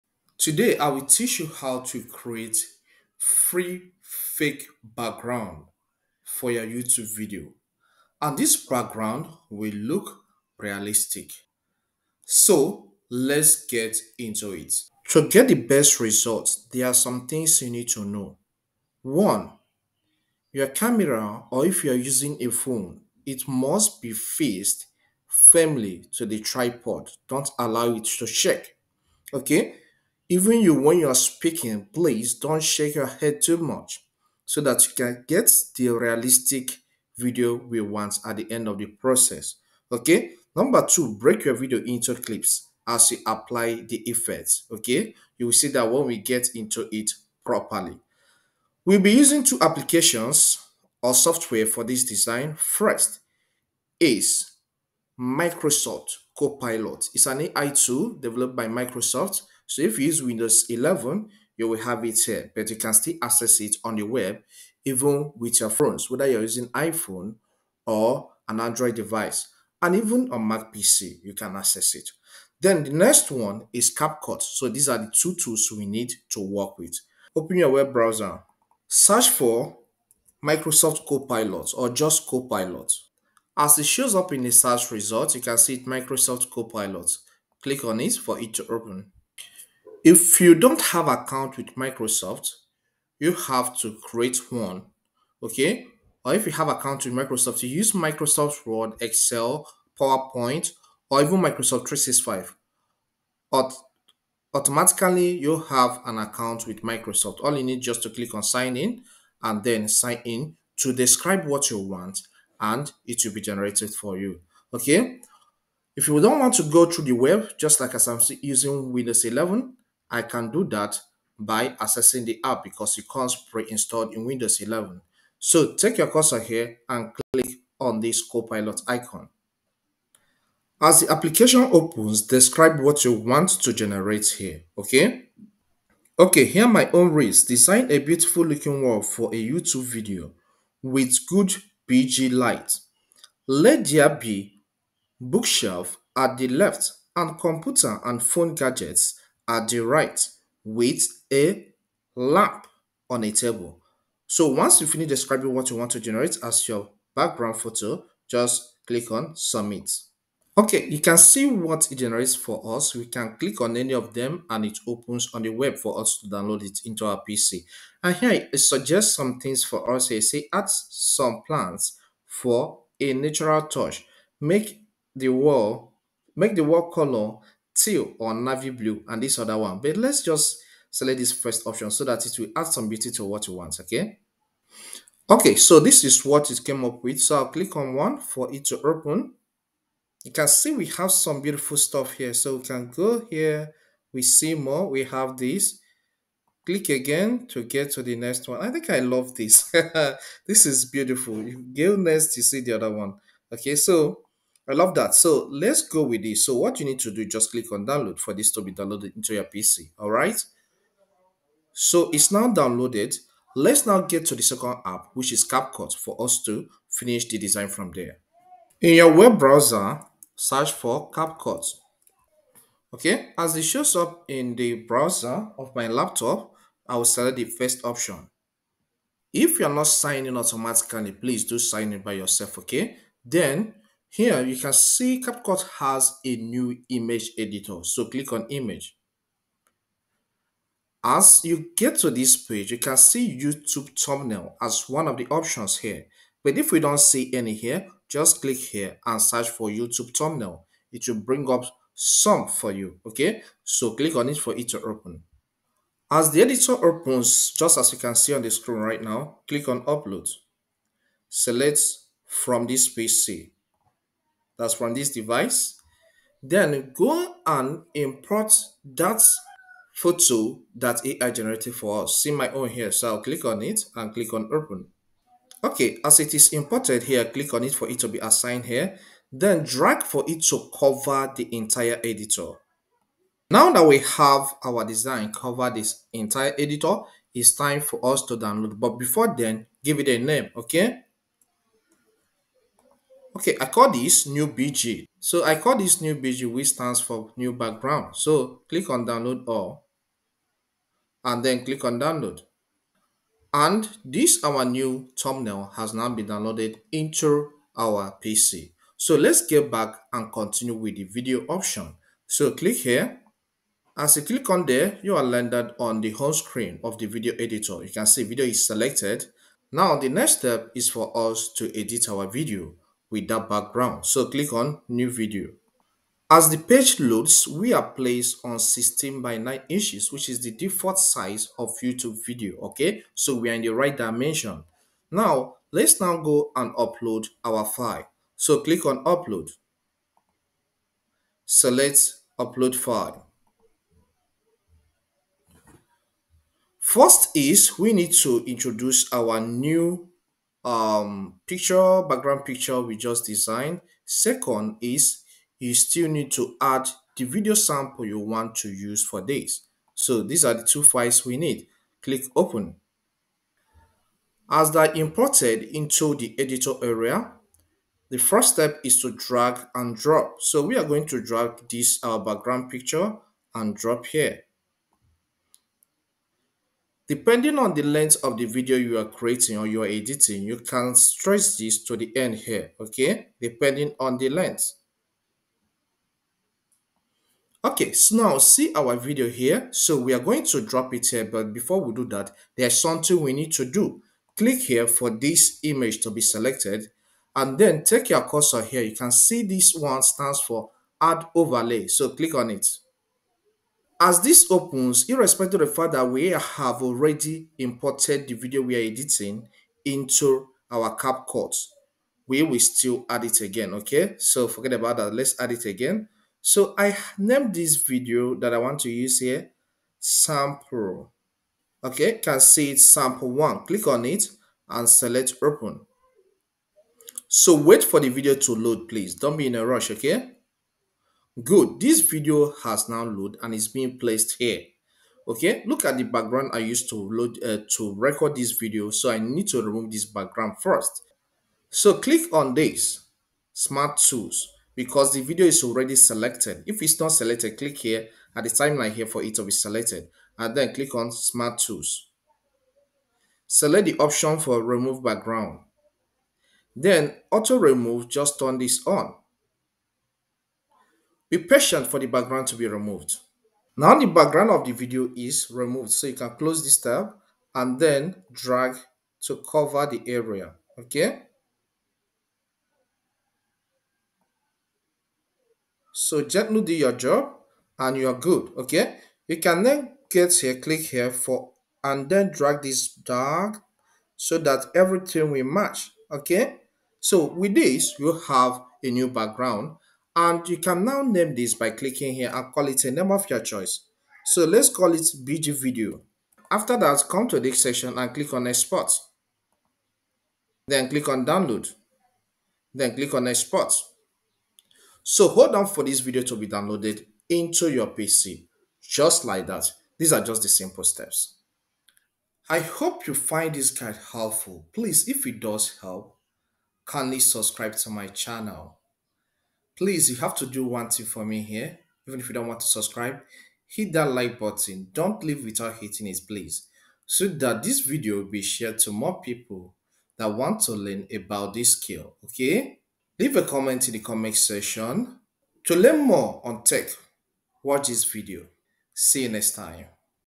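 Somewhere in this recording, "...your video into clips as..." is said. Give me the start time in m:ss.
0:41.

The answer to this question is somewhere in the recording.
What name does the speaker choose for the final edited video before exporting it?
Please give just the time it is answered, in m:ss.
8:15.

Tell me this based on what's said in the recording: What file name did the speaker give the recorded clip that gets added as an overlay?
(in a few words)
sample one.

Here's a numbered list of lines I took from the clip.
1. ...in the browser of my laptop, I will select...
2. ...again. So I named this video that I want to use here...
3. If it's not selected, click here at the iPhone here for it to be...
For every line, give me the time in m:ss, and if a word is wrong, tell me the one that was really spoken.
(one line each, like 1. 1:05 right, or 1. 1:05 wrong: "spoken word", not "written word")
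1. 3:44 right
2. 6:55 right
3. 7:26 wrong: "timeline", not "iPhone".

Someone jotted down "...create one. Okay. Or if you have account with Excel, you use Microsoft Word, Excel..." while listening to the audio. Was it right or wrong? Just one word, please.
wrong.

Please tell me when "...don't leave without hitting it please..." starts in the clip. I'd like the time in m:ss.
8:44.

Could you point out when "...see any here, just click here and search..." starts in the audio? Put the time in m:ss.
4:06.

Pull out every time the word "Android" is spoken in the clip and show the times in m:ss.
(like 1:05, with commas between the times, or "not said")
1:08.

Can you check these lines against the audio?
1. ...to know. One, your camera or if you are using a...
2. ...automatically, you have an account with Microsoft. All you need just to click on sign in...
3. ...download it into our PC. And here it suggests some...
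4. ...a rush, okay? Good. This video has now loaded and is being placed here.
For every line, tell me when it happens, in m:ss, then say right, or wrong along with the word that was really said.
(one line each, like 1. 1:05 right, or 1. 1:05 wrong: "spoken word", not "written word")
1. 0:17 right
2. 1:44 right
3. 2:46 right
4. 7:09 right.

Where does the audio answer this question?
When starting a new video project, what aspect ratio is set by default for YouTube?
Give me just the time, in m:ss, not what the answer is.
5:28.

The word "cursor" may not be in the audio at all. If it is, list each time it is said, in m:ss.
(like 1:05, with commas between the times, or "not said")
2:06, 6:38.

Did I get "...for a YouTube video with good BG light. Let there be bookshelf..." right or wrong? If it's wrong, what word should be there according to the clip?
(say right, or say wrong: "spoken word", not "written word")
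right.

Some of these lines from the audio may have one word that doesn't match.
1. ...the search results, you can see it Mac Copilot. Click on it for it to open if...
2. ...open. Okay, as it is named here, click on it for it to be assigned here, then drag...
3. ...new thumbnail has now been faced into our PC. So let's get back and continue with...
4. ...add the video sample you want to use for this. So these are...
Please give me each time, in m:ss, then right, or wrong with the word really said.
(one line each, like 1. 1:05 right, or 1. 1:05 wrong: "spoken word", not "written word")
1. 1:24 wrong: "Microsoft", not "Mac"
2. 4:34 wrong: "imported", not "named"
3. 5:04 wrong: "downloaded", not "faced"
4. 5:56 right.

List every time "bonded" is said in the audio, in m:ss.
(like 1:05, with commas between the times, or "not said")
not said.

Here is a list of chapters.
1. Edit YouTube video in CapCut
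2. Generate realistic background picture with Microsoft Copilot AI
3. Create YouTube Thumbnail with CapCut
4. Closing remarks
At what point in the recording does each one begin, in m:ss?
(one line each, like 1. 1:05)
1. 5:09
2. 1:17
3. 3:36
4. 8:32.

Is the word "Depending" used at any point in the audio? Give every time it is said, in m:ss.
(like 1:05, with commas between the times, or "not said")
6:17, 6:23.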